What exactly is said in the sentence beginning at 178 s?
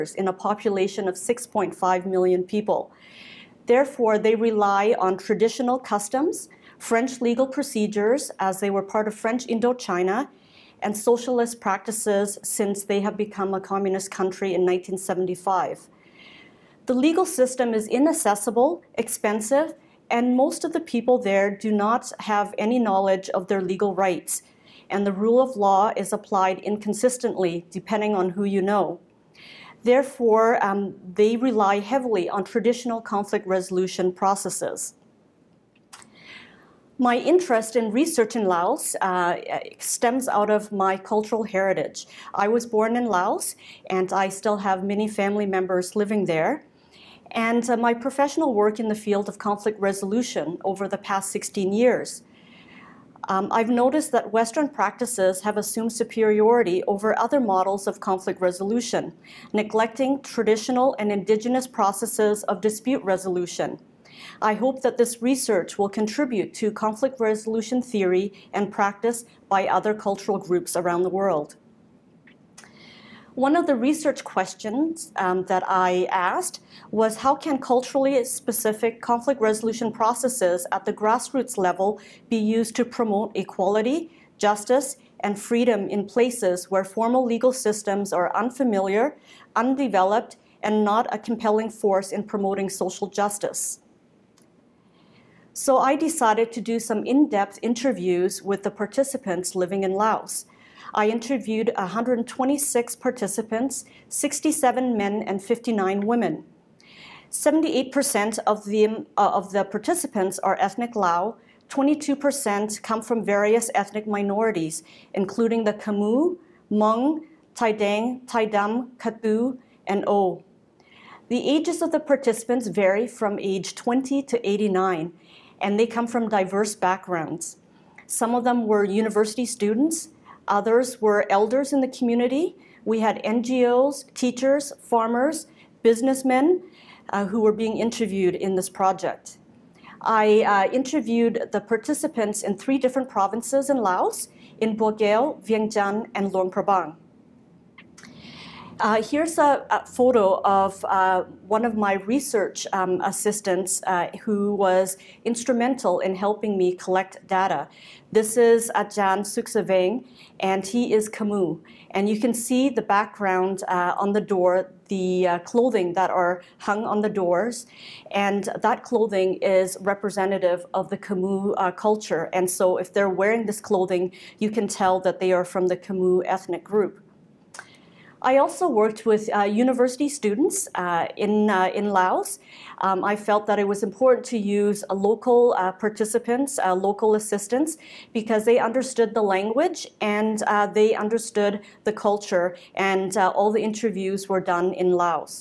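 I also worked with uh, university students uh, in, uh, in Laos.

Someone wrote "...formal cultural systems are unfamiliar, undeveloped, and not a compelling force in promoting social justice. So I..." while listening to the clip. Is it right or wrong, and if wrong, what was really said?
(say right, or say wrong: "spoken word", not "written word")
wrong: "legal", not "cultural".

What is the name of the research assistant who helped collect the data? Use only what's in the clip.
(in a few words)
Ajahn Suksaveng.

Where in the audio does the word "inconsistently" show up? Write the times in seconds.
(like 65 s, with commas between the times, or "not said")
26 s.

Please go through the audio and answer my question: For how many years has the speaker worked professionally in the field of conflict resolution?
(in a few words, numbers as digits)
16.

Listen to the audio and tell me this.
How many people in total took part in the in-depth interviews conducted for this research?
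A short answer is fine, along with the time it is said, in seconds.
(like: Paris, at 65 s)
126, at 101 s.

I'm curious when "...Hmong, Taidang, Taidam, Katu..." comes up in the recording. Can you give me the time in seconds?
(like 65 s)
116 s.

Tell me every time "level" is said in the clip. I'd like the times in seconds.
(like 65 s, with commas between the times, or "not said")
81 s.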